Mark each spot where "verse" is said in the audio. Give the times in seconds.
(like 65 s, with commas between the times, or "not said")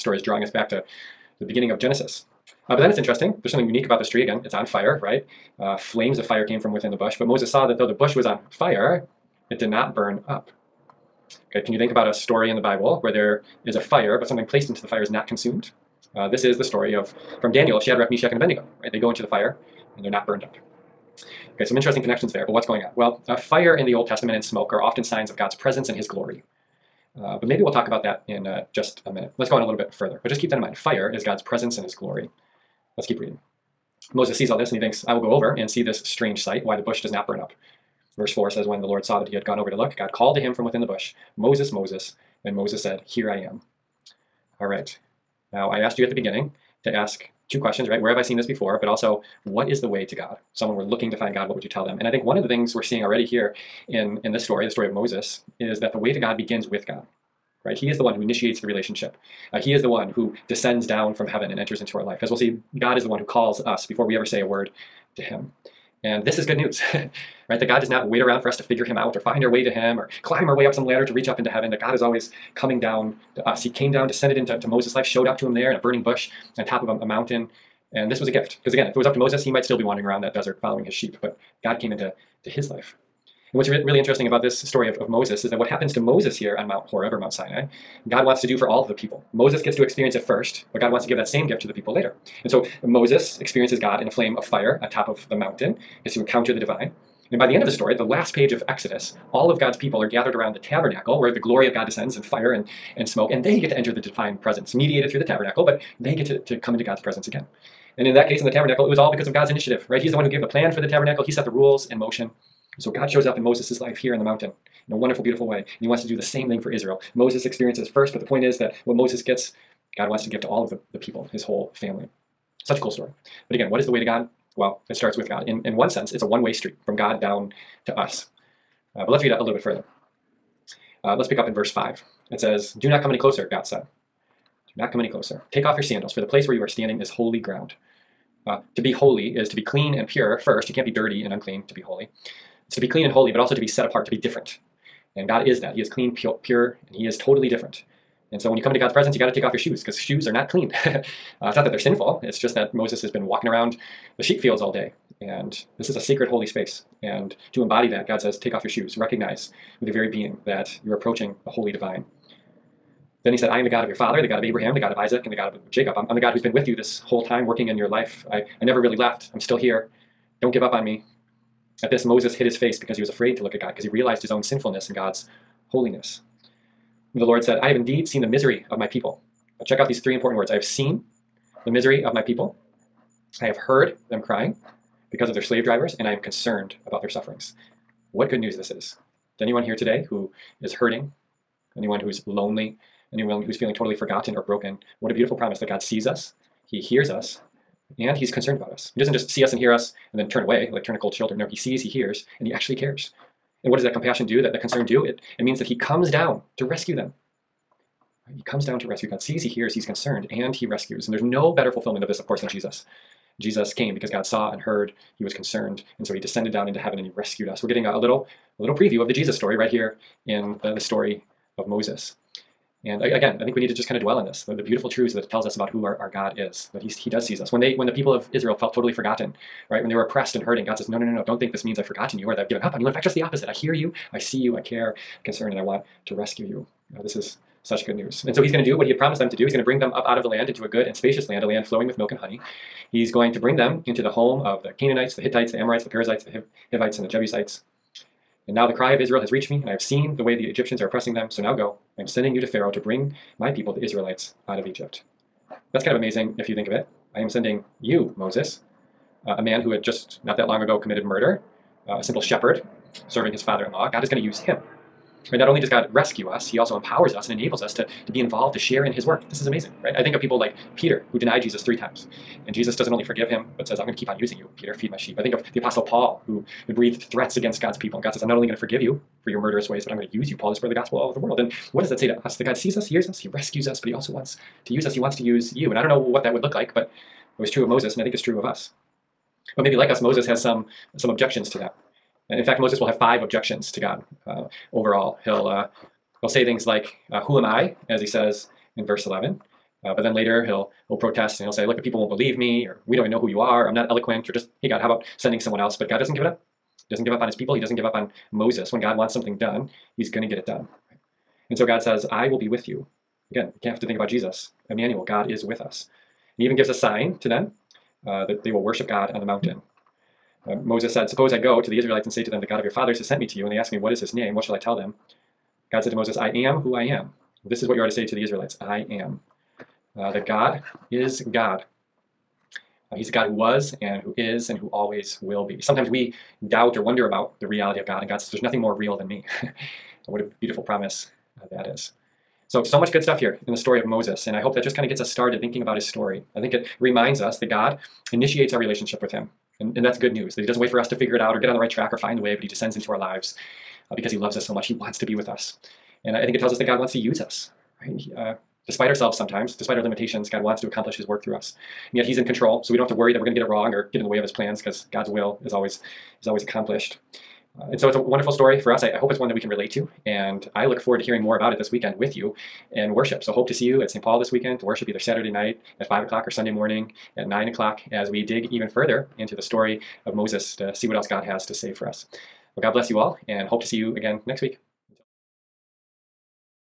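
38 s, 131 s, 298 s.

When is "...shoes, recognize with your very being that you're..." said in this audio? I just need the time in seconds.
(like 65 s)
158 s.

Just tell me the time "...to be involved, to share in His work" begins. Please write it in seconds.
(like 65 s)
268 s.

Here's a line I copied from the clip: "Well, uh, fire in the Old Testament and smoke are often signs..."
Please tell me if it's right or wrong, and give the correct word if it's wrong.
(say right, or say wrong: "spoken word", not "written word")
right.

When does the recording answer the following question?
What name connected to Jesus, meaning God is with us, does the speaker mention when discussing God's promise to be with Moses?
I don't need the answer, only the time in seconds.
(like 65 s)
314 s.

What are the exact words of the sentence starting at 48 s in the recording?
Where have I seen this before?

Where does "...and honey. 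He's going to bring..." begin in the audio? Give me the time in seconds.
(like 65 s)
242 s.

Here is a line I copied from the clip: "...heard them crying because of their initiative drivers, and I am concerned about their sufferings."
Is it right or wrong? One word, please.
wrong.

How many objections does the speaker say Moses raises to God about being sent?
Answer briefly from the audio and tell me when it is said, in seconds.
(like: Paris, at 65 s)
5, at 292 s.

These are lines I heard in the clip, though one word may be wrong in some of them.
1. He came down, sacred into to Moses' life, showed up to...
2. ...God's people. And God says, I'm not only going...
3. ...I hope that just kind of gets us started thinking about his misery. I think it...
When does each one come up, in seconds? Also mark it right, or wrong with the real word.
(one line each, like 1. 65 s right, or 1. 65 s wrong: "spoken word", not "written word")
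1. 73 s wrong: "descended", not "sacred"
2. 277 s right
3. 344 s wrong: "story", not "misery".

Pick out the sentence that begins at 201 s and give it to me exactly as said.
No, He sees, He hears, and He actually cares.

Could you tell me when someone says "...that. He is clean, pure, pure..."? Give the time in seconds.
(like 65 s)
145 s.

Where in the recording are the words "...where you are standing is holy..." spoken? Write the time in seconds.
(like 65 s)
136 s.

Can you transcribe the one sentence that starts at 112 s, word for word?
So God shows up in Moses' life here in the mountain in a wonderful, beautiful way.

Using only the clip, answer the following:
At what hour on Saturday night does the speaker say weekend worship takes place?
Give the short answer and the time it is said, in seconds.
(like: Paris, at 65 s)
5 o'clock, at 375 s.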